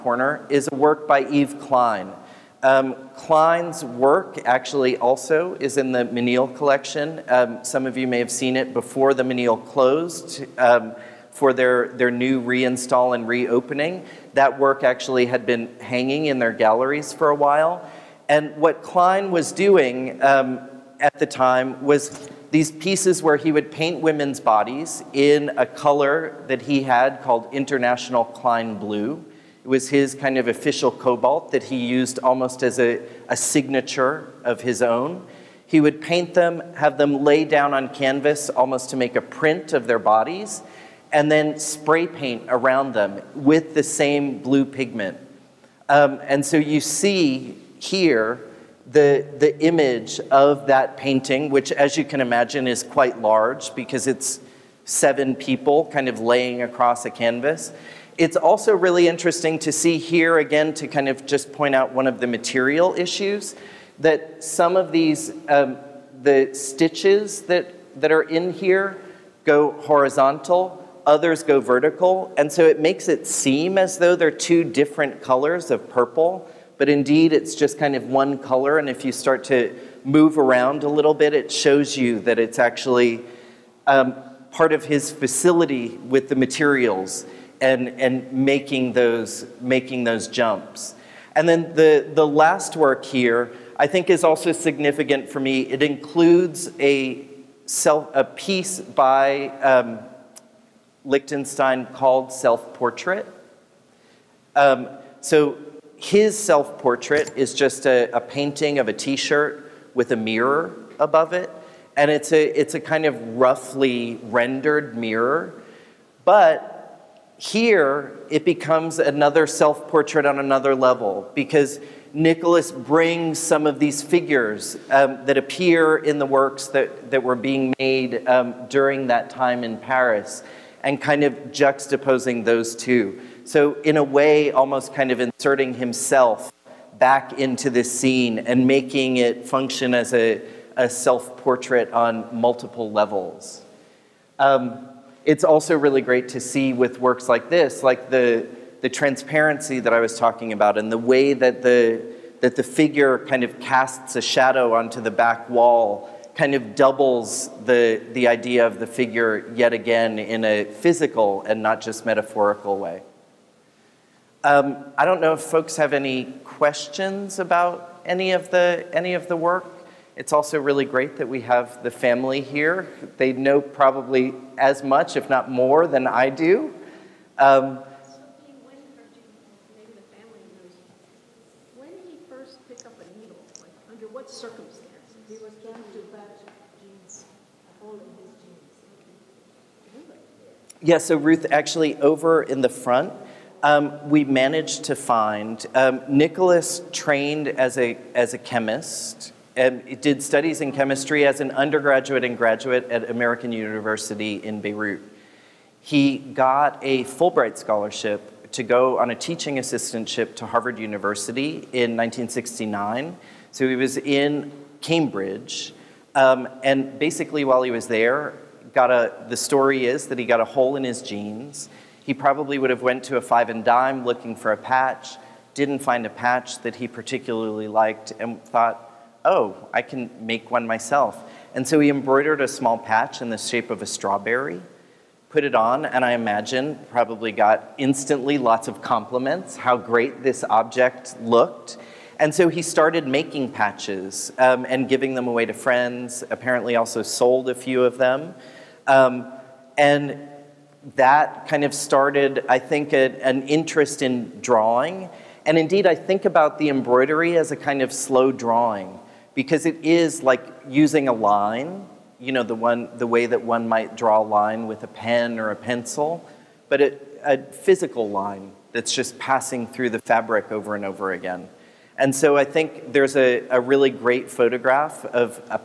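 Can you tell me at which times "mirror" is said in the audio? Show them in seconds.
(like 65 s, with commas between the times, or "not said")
110 s, 114 s.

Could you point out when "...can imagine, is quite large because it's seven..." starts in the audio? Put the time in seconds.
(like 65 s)
52 s.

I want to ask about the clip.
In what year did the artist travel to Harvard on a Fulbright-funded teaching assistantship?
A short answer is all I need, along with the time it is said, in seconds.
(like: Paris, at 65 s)
1969, at 211 s.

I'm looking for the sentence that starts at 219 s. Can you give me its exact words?
The story is that he got a hole in his jeans.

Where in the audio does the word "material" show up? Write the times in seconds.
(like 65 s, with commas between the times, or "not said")
62 s, 86 s.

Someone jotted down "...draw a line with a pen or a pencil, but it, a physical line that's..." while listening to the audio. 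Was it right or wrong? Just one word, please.
right.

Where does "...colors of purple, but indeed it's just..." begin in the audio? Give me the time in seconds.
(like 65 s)
75 s.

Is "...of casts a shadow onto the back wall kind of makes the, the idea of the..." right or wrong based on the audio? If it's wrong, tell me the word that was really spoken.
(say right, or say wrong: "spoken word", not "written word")
wrong: "doubles", not "makes".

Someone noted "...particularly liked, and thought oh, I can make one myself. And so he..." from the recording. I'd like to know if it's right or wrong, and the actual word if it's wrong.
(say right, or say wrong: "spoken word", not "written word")
right.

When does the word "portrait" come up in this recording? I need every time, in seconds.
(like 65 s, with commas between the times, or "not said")
102 s, 106 s, 119 s, 141 s.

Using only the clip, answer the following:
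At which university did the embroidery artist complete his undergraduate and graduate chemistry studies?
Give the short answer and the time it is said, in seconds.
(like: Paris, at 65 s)
American University in Beirut, at 203 s.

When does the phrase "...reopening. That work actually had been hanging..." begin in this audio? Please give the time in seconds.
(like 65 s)
13 s.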